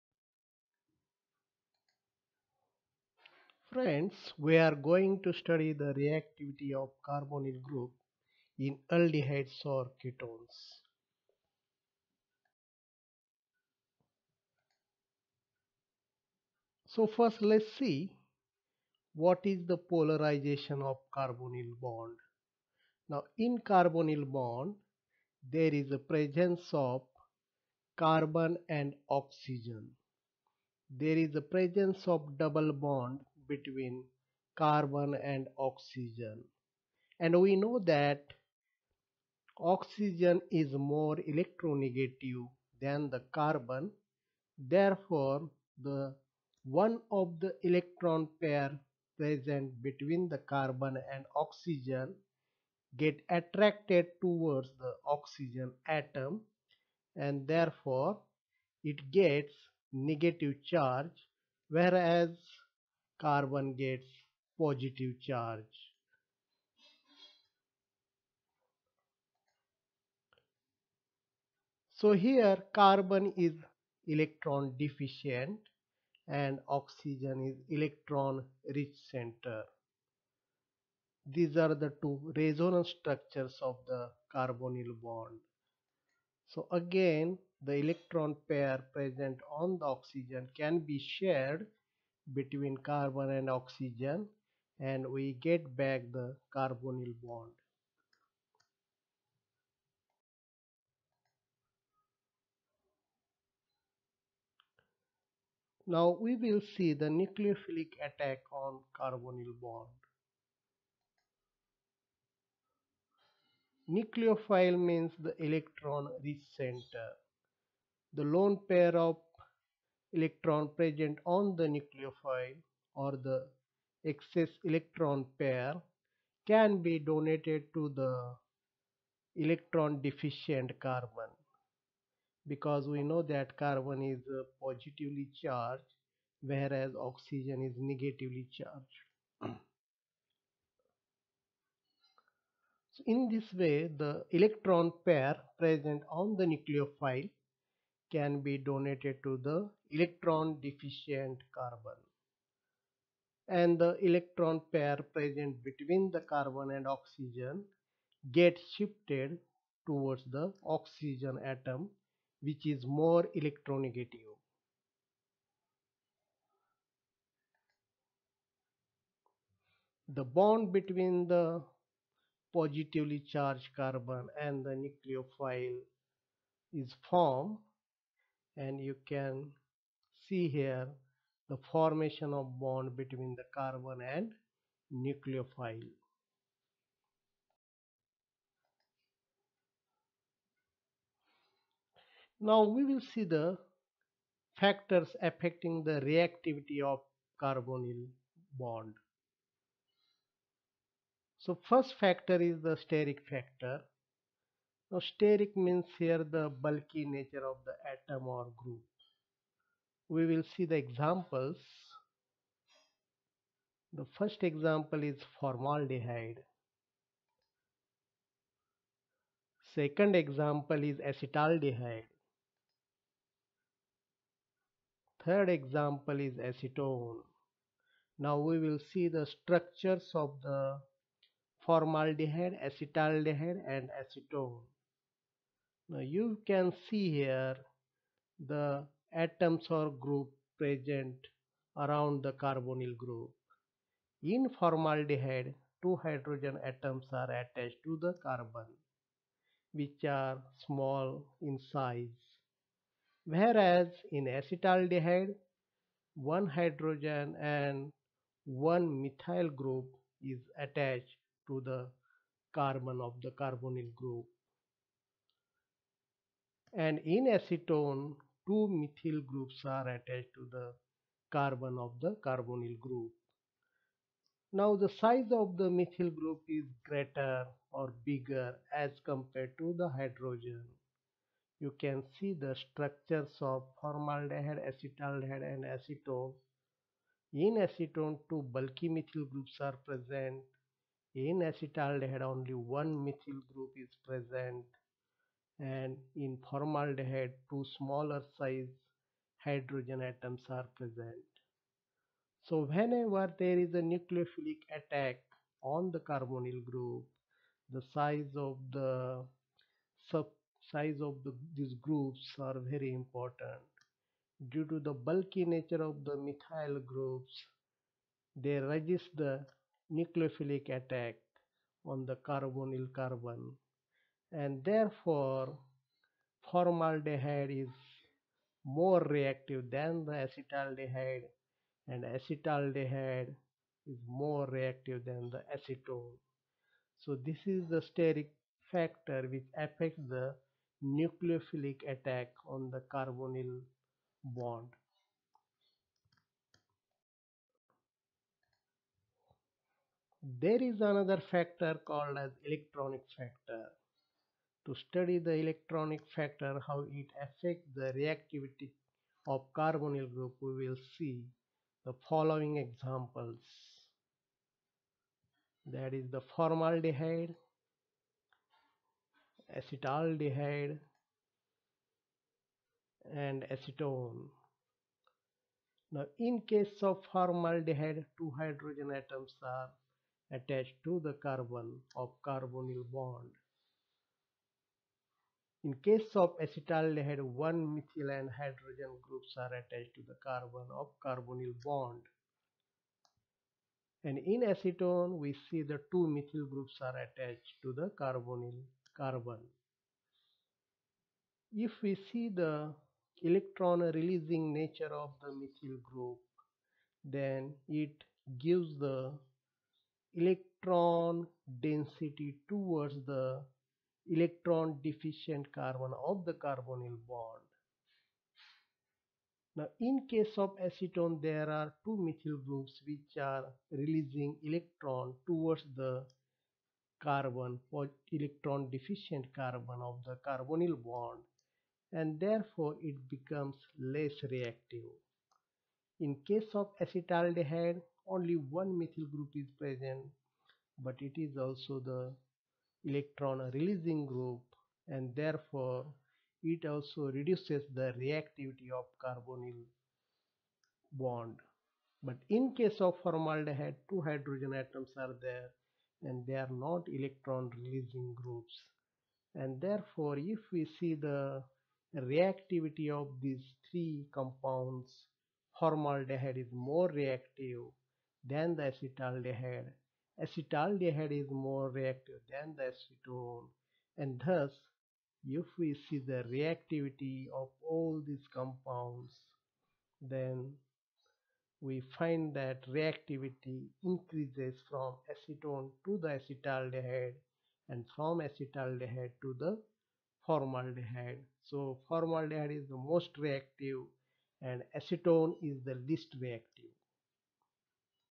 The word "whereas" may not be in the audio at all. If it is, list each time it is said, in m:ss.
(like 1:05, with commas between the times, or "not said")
1:01, 2:16, 4:13.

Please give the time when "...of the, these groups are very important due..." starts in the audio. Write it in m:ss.
5:11.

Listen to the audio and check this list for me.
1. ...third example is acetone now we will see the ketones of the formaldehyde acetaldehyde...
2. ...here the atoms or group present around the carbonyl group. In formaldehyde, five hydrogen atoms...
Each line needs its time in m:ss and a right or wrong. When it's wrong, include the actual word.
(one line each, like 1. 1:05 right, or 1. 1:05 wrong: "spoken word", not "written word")
1. 3:45 wrong: "structures", not "ketones"
2. 3:57 wrong: "two", not "five".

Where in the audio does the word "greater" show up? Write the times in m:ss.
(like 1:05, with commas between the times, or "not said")
4:36.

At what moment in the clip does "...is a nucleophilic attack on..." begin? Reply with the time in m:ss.
5:03.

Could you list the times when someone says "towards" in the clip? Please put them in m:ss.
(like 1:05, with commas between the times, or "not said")
0:54, 2:39, 6:52, 7:05.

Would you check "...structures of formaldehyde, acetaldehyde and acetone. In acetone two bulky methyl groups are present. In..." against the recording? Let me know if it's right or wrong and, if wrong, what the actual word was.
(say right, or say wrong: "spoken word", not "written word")
right.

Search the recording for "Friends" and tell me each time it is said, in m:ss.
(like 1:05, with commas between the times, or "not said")
0:03.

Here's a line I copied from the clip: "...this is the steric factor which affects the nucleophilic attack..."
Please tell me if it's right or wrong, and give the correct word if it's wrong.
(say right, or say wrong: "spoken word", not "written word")
right.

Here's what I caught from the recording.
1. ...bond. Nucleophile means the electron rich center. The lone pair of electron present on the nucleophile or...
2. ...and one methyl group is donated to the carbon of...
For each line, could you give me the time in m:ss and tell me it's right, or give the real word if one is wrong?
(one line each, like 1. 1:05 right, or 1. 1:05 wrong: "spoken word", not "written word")
1. 1:49 right
2. 4:17 wrong: "attached", not "donated".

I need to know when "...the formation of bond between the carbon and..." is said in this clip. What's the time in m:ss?
3:01.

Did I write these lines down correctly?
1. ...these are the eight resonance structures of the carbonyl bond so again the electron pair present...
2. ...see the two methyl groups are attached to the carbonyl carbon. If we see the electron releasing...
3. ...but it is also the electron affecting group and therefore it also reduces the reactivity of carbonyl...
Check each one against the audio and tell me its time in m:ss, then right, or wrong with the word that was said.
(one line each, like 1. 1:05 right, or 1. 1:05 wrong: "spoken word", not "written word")
1. 1:21 wrong: "two", not "eight"
2. 6:35 right
3. 7:20 wrong: "releasing", not "affecting".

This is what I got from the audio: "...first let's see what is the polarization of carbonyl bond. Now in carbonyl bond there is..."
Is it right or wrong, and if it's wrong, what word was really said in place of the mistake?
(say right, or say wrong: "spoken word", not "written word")
right.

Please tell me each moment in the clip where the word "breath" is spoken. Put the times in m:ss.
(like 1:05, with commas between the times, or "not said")
not said.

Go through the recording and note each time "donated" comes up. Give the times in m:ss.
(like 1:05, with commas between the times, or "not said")
2:06, 2:28.